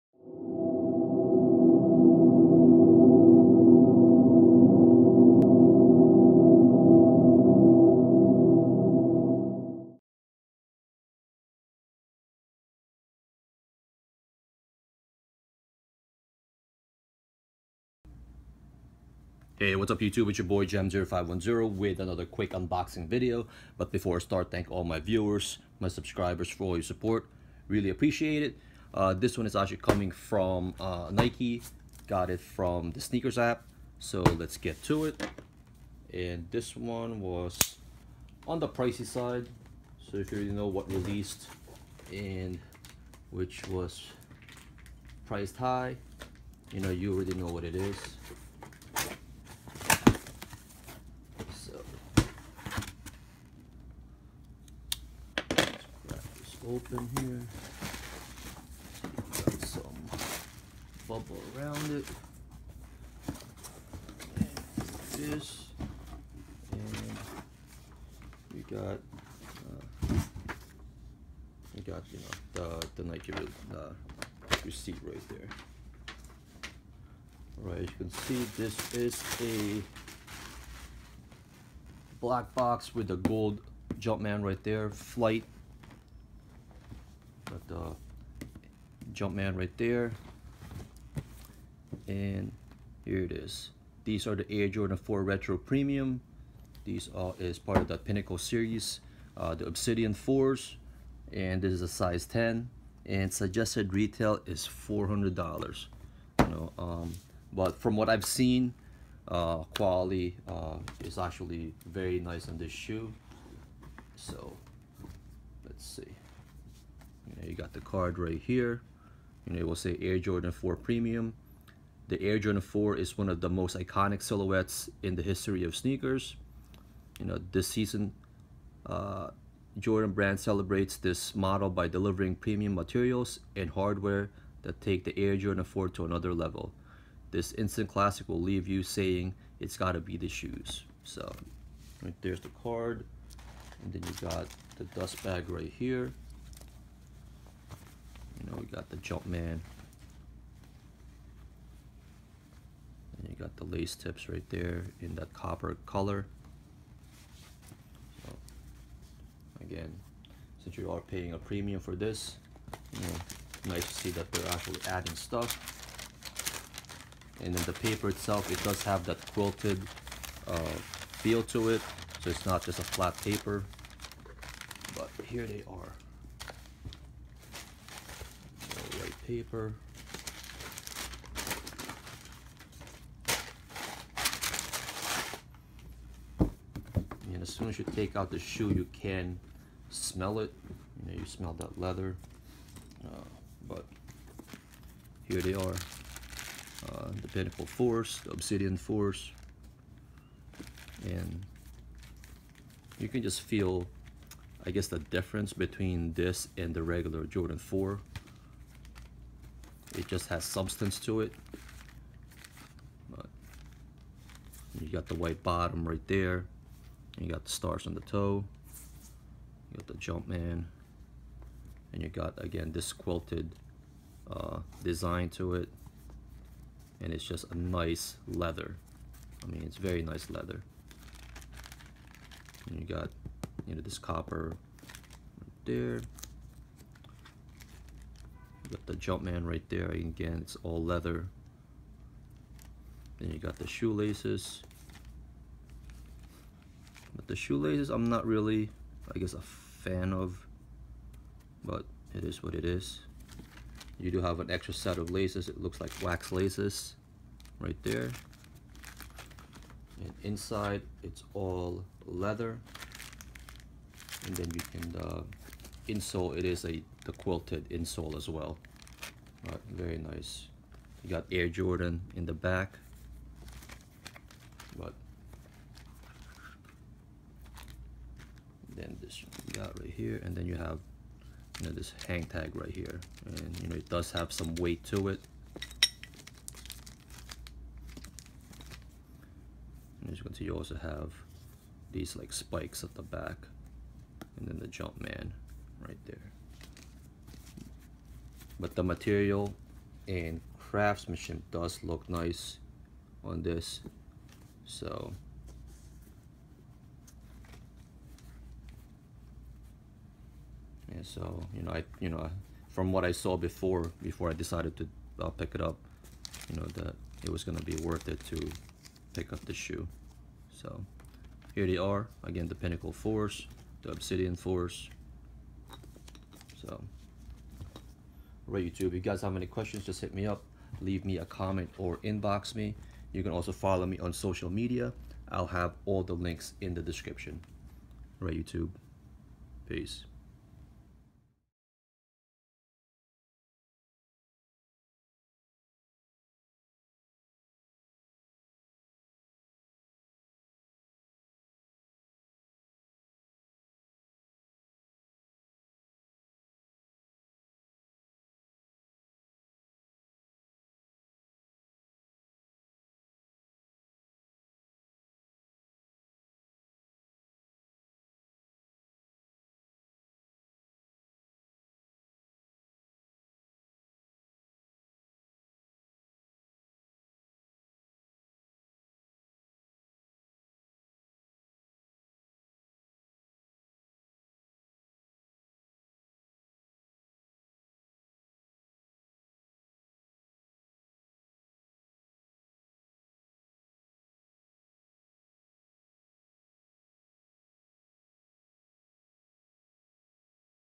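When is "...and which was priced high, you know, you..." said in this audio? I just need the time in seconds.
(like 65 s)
42 s.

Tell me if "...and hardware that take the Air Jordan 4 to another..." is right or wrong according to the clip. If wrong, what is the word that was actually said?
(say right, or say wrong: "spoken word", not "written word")
right.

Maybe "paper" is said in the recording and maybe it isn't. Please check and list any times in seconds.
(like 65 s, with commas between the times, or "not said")
167 s, 173 s, 179 s.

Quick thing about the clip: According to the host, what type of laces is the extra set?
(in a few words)
wax laces.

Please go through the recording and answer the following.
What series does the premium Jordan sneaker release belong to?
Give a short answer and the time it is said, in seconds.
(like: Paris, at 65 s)
Pinnacle series, at 97 s.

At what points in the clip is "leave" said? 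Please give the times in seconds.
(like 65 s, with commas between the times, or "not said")
138 s, 330 s.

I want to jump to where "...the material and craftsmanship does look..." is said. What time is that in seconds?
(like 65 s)
298 s.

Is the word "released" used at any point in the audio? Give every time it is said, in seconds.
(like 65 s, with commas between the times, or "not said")
40 s.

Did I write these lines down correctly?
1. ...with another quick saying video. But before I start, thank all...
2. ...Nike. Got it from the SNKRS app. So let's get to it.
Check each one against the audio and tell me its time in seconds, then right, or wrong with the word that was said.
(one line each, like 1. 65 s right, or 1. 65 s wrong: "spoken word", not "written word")
1. 21 s wrong: "unboxing", not "saying"
2. 31 s right.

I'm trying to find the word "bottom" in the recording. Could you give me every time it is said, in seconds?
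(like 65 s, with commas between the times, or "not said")
215 s.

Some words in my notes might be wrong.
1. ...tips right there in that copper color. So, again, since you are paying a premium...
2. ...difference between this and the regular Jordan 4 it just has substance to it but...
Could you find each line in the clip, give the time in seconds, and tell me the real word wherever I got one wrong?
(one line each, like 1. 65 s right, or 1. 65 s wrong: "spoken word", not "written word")
1. 153 s right
2. 204 s right.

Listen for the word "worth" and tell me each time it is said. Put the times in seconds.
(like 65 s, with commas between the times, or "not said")
317 s.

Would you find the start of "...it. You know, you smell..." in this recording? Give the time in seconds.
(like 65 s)
190 s.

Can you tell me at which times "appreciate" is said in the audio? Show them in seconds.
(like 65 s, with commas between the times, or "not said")
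27 s.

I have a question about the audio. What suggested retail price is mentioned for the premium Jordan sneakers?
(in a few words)
$400.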